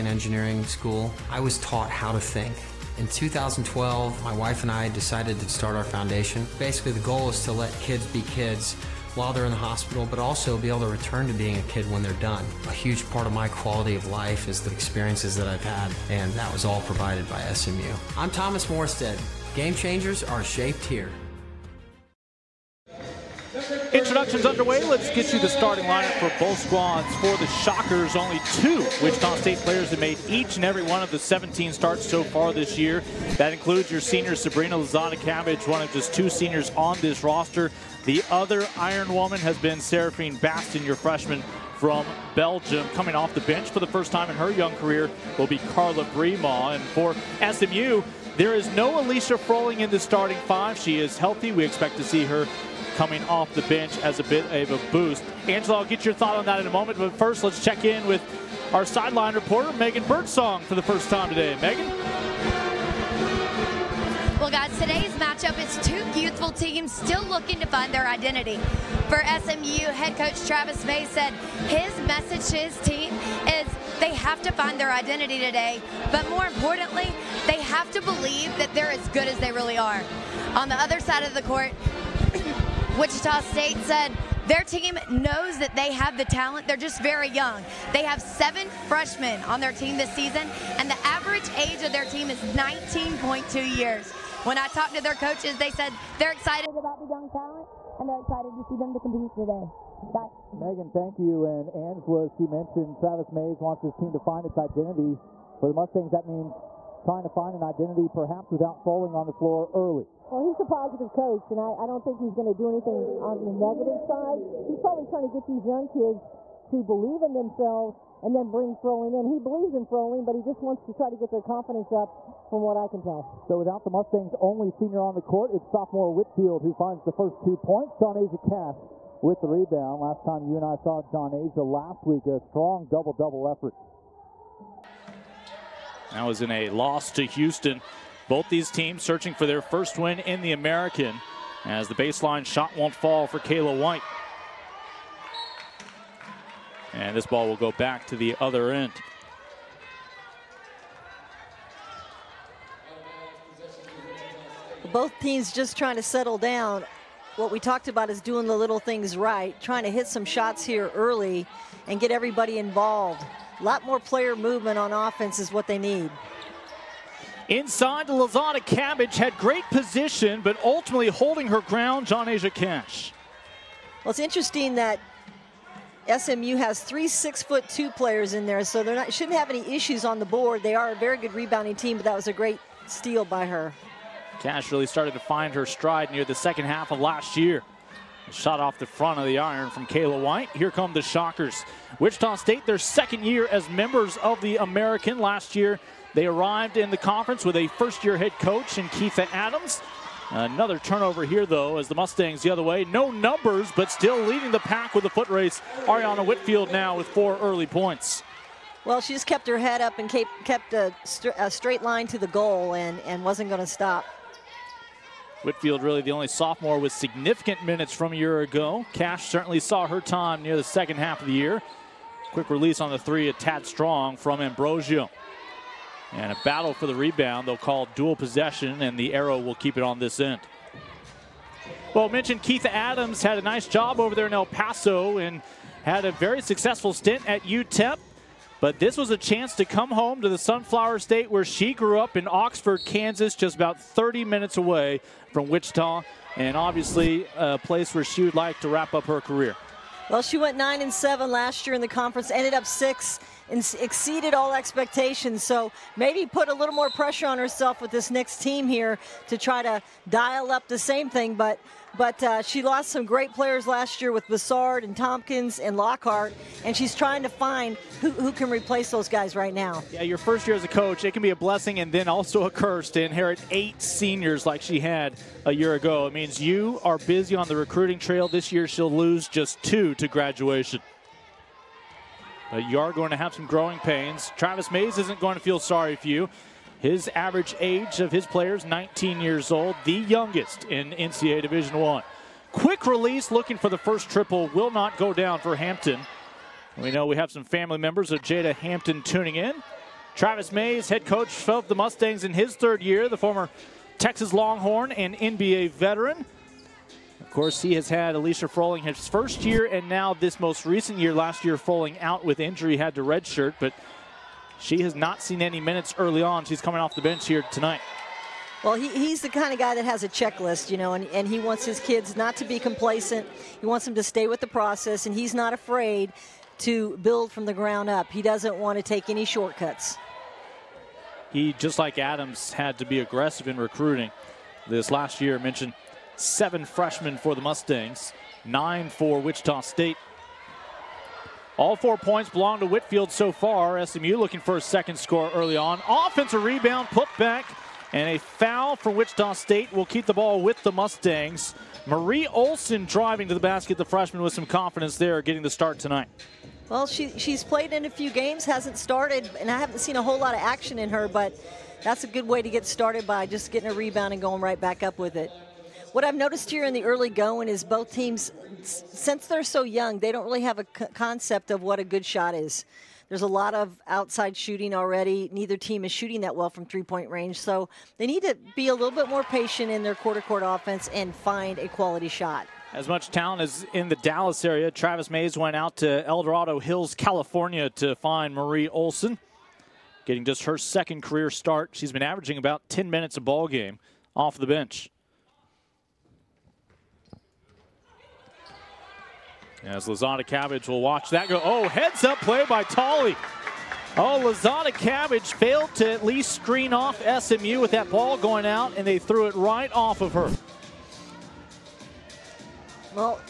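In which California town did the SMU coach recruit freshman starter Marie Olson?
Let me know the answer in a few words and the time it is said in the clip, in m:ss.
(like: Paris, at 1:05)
El Dorado Hills, at 6:26.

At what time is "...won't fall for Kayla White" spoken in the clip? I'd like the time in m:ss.
2:22.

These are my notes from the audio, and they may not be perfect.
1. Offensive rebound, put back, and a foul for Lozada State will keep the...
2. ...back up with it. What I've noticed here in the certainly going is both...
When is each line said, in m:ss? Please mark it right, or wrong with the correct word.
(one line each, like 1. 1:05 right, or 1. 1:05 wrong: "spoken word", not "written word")
1. 5:45 wrong: "Wichita", not "Lozada"
2. 6:04 wrong: "early", not "certainly".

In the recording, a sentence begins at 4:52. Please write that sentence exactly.
Quick release, looking for the first triple, will not go down for Hampton.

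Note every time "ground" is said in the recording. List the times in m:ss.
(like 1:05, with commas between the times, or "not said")
2:51, 5:27.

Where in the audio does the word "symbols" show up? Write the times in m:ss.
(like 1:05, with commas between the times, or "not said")
not said.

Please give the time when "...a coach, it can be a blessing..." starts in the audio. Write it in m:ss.
4:30.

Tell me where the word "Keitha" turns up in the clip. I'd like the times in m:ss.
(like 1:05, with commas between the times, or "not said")
3:18, 3:52.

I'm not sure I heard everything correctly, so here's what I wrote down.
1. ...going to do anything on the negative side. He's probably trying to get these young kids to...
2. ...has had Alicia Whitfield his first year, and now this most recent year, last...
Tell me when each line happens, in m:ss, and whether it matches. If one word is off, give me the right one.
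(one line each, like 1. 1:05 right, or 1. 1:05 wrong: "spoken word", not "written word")
1. 1:52 right
2. 5:07 wrong: "Froling", not "Whitfield".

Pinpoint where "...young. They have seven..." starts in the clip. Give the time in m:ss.
1:27.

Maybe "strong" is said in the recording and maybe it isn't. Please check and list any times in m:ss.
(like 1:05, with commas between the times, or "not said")
2:12, 3:43.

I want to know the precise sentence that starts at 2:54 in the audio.
Well, it's interesting that SMU has three six-foot-two players in there, so they are not shouldn't have any issues on the board.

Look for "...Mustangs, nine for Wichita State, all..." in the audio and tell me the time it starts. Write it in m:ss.
5:37.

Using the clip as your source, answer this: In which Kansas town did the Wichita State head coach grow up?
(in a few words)
Oxford, Kansas.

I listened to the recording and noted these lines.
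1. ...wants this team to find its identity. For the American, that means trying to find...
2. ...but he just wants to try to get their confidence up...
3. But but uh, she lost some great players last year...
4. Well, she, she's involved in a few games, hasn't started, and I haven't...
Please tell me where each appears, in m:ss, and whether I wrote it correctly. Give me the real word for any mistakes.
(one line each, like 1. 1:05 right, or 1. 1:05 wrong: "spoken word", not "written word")
1. 1:43 wrong: "Mustangs", not "American"
2. 2:00 right
3. 4:21 right
4. 5:56 wrong: "played", not "involved".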